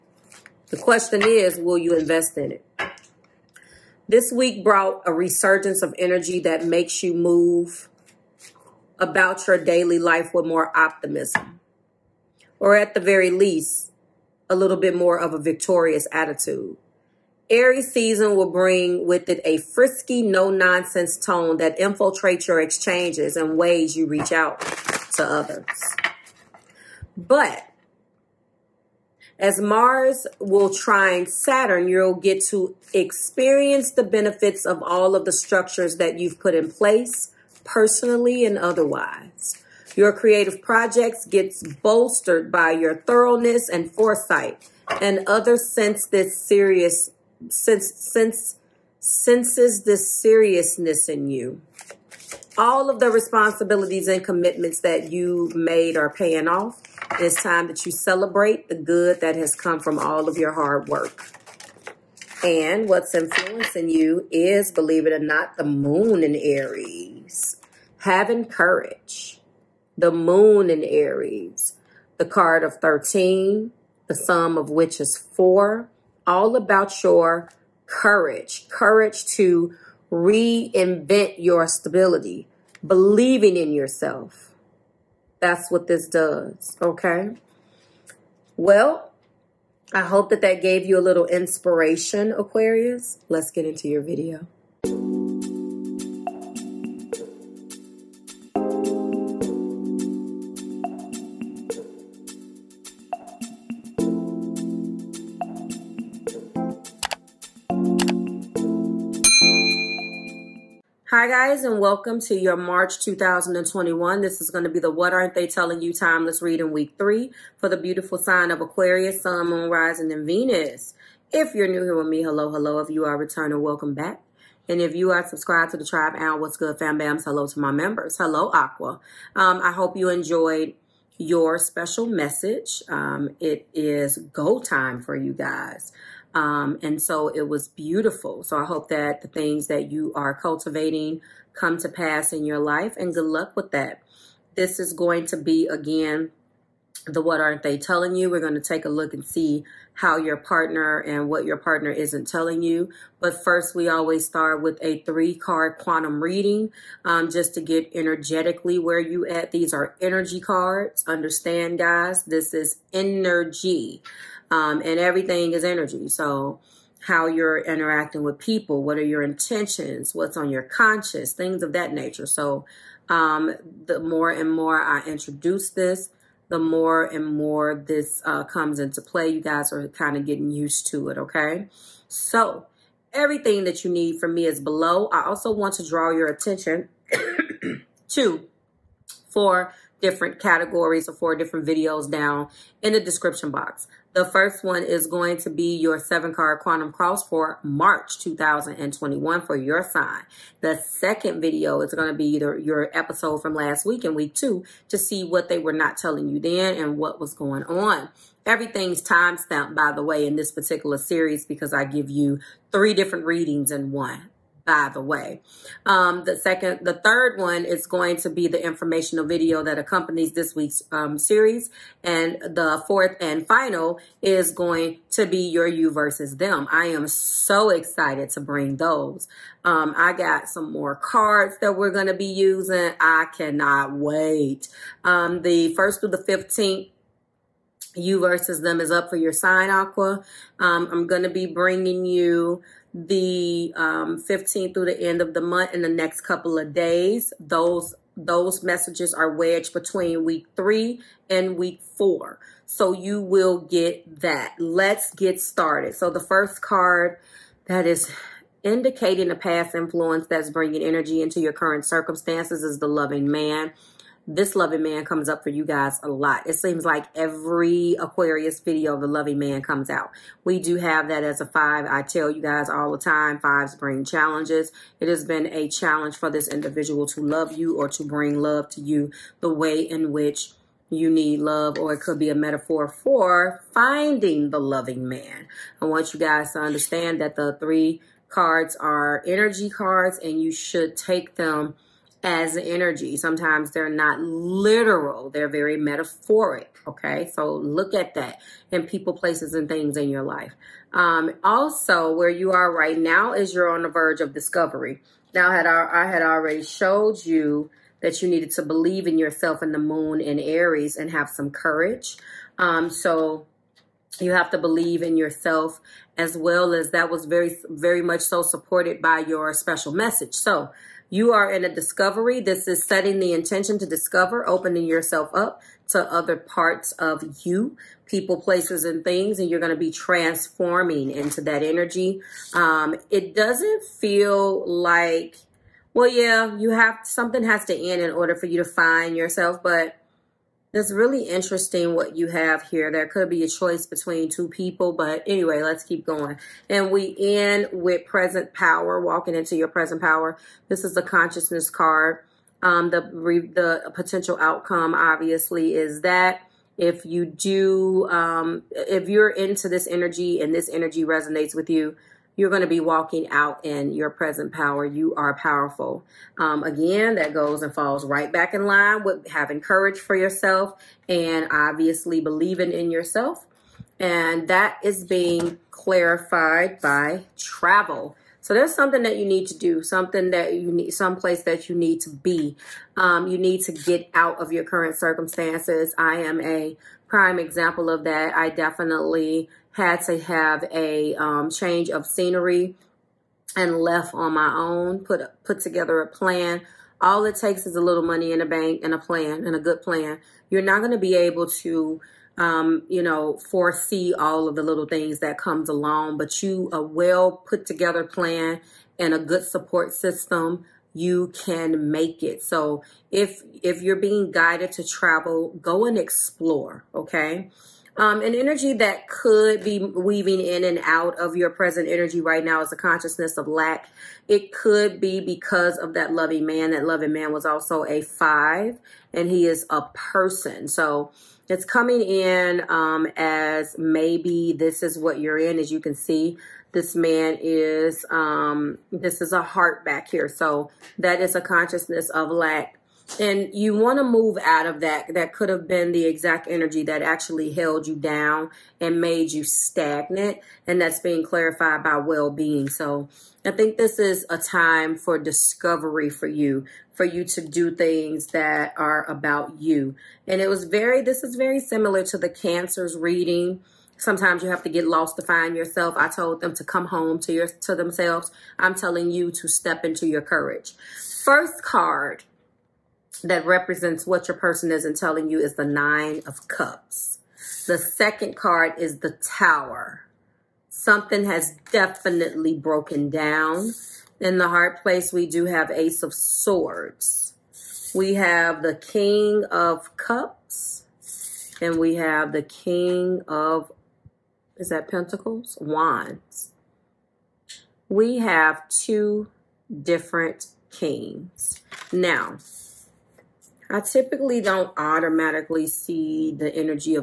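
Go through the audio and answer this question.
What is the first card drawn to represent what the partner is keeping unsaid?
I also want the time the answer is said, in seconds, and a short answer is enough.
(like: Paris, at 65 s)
Nine of Cups, at 475 s.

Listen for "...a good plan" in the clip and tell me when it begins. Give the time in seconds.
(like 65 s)
399 s.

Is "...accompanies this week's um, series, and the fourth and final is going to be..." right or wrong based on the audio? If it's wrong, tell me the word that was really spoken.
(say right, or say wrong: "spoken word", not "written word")
right.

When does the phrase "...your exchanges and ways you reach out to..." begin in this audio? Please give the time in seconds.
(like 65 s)
22 s.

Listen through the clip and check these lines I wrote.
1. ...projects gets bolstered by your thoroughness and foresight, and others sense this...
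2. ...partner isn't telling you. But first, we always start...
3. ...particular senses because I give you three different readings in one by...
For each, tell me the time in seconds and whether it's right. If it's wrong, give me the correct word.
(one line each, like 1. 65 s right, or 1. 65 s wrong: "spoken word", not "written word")
1. 40 s right
2. 151 s right
3. 210 s wrong: "series", not "senses".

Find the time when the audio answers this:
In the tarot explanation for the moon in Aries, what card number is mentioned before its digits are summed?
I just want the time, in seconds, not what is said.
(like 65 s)
72 s.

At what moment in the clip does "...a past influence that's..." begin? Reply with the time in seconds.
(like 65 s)
259 s.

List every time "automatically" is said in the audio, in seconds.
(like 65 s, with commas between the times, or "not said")
504 s.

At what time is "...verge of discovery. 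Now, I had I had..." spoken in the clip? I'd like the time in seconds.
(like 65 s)
303 s.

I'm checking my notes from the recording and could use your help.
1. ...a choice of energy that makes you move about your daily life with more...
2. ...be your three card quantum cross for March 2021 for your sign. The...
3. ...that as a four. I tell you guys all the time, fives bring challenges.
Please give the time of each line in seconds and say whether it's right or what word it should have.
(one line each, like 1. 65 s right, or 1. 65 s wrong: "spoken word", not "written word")
1. 5 s wrong: "resurgence", not "choice"
2. 195 s wrong: "seven", not "three"
3. 271 s wrong: "five", not "four".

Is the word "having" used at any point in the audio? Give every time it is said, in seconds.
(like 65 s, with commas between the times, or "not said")
67 s, 369 s.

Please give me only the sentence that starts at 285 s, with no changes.
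I want you guys to understand that the three cards are energy cards and you should take them as energy.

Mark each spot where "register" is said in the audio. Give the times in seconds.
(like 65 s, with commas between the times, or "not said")
not said.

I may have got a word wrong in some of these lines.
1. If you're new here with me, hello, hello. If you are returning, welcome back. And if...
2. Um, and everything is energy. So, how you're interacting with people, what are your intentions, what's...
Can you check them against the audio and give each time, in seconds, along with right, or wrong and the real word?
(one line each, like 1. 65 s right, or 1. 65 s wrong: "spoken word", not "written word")
1. 121 s right
2. 164 s right.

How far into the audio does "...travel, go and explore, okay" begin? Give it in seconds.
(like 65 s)
414 s.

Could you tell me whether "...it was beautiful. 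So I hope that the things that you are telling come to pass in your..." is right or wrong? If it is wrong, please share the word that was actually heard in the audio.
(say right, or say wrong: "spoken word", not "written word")
wrong: "cultivating", not "telling".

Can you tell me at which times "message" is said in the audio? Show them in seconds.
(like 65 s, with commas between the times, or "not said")
132 s, 248 s, 319 s.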